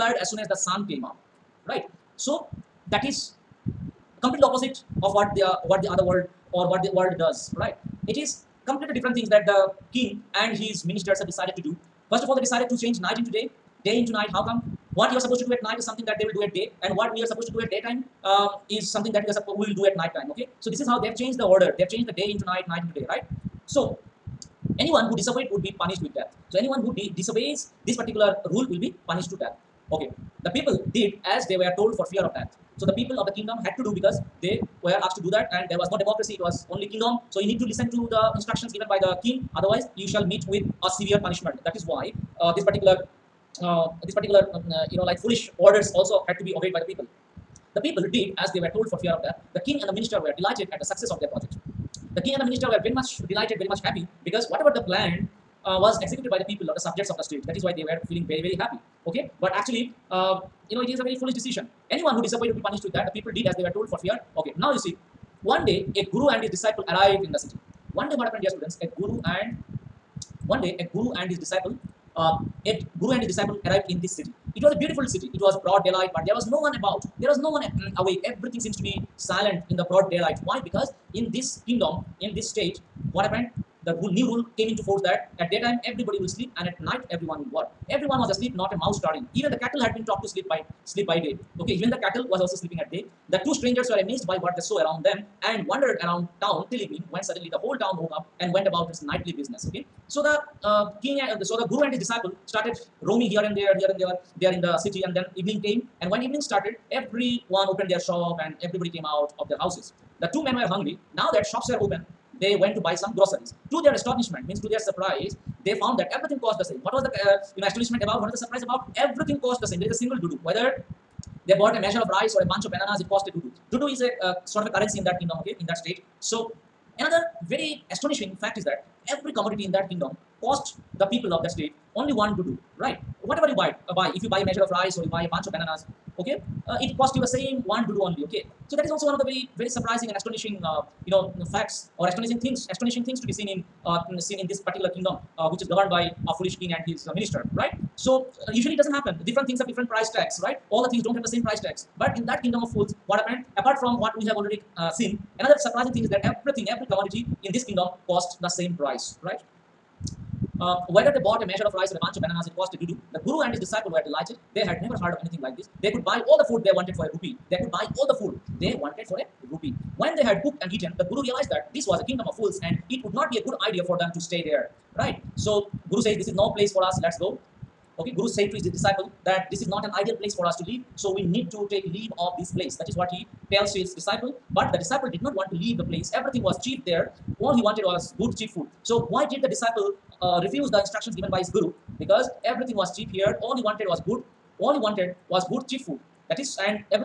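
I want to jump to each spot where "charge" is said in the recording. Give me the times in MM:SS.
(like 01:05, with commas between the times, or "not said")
not said.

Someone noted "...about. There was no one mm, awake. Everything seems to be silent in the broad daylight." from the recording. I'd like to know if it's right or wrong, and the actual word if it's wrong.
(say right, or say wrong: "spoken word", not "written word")
right.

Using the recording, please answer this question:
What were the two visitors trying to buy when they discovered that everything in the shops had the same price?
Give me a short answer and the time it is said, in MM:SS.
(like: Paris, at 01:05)
Groceries, at 01:53.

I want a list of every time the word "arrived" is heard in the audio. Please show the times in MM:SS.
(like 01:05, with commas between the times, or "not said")
01:06, 01:13.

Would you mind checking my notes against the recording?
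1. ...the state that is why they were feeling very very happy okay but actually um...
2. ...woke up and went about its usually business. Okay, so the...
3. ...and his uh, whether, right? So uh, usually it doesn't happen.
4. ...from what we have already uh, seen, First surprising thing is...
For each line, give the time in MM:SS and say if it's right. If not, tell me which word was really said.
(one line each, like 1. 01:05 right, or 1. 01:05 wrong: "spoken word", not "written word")
1. 00:57 right
2. 01:37 wrong: "nightly", not "usually"
3. 02:26 wrong: "minister", not "whether"
4. 02:33 wrong: "Another", not "First".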